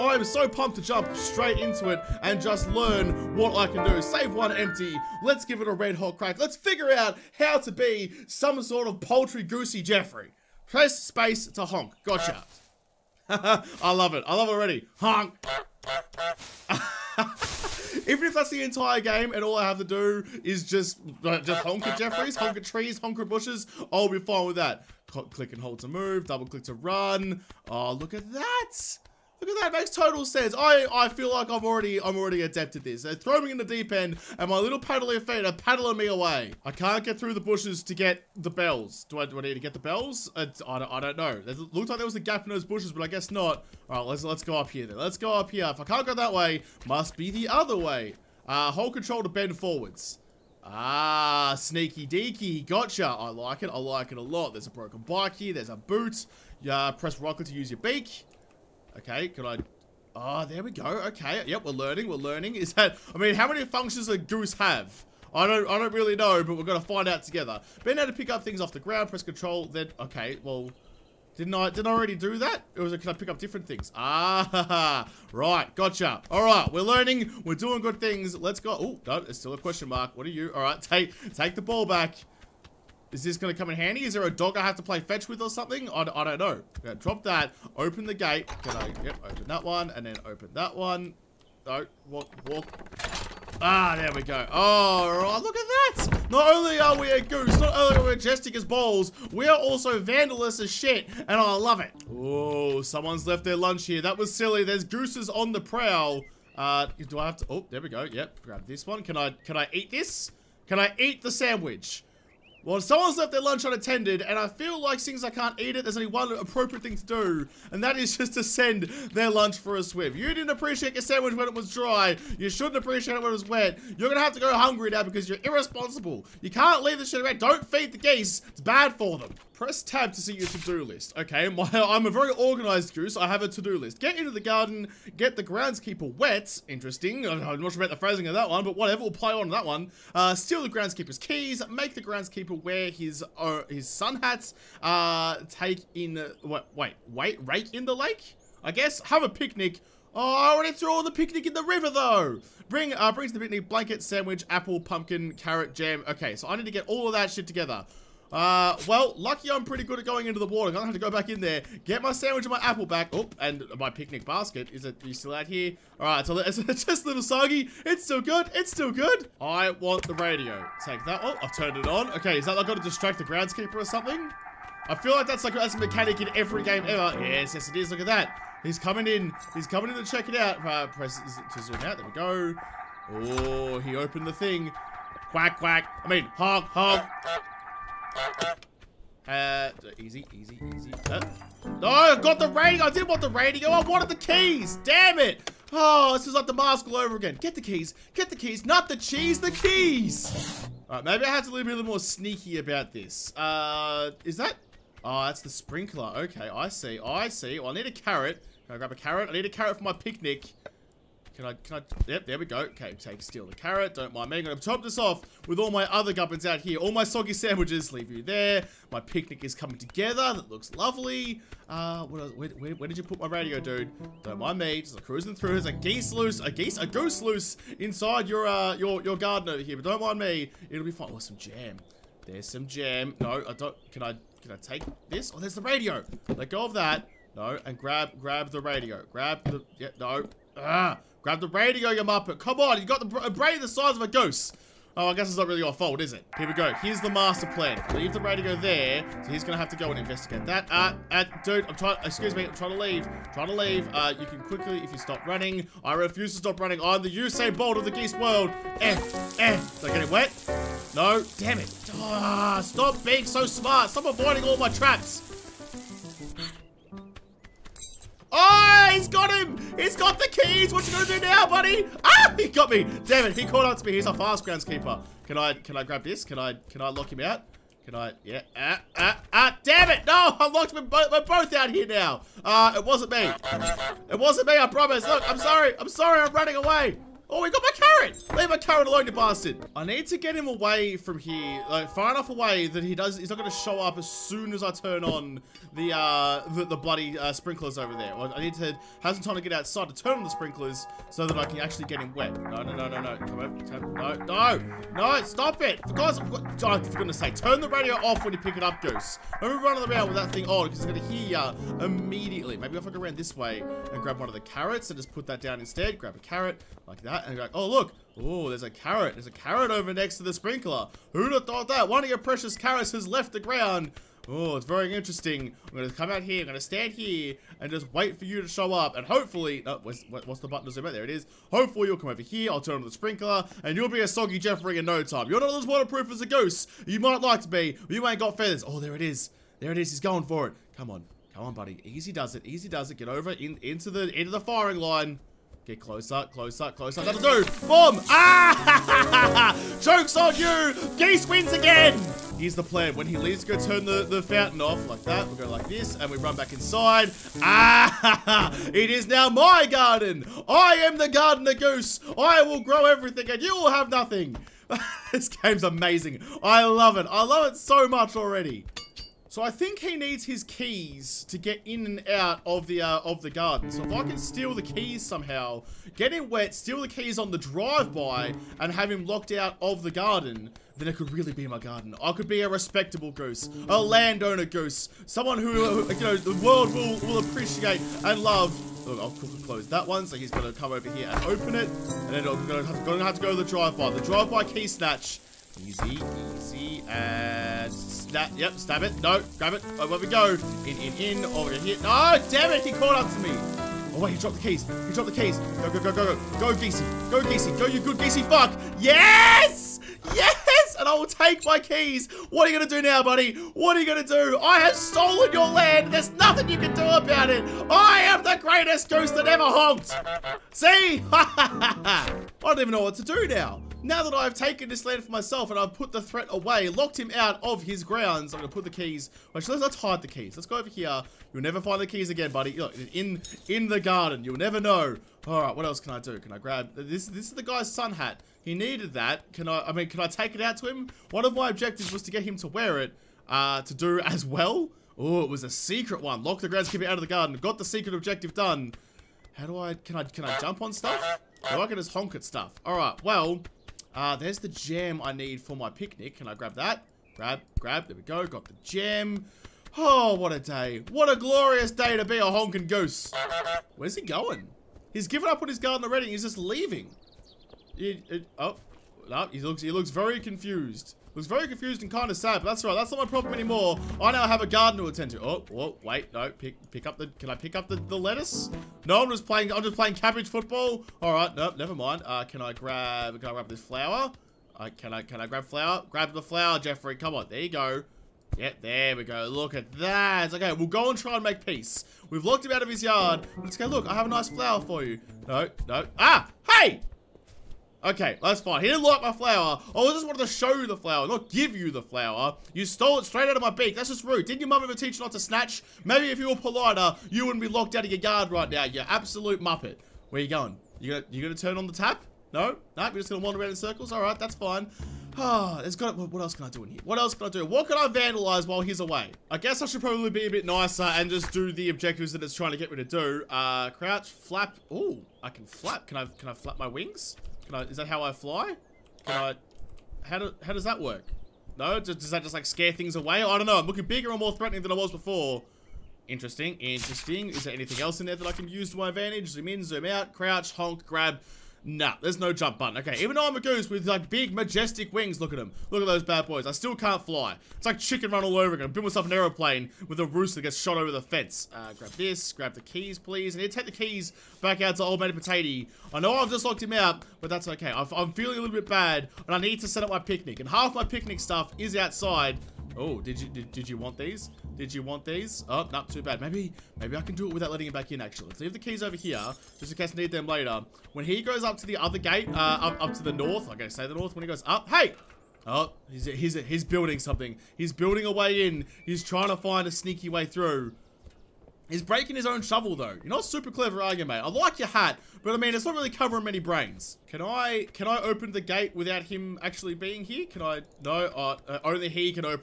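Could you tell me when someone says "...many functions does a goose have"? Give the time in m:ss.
1:03.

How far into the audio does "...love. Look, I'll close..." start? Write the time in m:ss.
6:28.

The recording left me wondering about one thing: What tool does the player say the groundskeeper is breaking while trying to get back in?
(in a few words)
Shovel.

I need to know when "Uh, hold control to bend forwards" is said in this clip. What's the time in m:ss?
0:48.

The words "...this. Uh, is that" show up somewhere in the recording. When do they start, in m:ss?
3:22.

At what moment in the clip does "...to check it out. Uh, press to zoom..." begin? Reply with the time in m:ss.
3:00.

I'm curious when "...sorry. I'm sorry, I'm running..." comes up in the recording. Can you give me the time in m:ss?
4:45.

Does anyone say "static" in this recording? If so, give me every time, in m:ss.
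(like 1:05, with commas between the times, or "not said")
not said.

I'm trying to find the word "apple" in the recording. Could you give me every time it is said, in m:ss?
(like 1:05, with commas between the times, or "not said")
2:34, 2:42.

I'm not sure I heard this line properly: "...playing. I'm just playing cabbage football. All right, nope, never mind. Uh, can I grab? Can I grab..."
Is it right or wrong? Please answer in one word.
right.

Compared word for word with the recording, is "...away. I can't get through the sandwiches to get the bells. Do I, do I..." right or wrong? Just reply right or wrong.
wrong.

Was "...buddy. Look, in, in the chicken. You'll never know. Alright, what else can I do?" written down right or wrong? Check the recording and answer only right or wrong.
wrong.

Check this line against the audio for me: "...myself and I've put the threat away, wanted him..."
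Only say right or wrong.
wrong.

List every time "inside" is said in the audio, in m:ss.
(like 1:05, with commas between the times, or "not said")
3:47, 5:56.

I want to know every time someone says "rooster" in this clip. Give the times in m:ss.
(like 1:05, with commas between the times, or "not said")
9:10.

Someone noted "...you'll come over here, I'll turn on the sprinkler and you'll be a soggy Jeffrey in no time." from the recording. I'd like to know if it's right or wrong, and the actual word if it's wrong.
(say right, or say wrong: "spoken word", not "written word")
right.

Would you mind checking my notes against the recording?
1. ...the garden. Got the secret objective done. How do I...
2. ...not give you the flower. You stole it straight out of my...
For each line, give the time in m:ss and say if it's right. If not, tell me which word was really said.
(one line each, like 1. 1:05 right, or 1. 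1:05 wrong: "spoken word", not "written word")
1. 7:26 right
2. 8:21 right.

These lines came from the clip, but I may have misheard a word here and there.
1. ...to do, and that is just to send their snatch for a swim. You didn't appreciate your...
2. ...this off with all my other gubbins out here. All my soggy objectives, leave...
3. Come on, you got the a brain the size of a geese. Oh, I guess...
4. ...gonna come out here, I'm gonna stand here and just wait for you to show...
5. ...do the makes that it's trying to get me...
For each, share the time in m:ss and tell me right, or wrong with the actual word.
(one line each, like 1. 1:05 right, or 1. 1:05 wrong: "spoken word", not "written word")
1. 1:56 wrong: "lunch", not "snatch"
2. 3:34 wrong: "sandwiches", not "objectives"
3. 4:02 wrong: "goose", not "geese"
4. 5:25 right
5. 8:41 wrong: "objectives", not "makes".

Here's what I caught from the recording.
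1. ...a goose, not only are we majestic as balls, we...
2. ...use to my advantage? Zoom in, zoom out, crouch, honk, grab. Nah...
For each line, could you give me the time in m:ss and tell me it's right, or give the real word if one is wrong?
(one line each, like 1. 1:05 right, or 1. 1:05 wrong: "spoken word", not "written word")
1. 1:37 right
2. 8:58 right.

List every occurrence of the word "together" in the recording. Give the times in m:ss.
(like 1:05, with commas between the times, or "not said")
1:07, 2:37, 3:39.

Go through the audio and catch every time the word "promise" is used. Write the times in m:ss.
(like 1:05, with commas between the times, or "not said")
4:44.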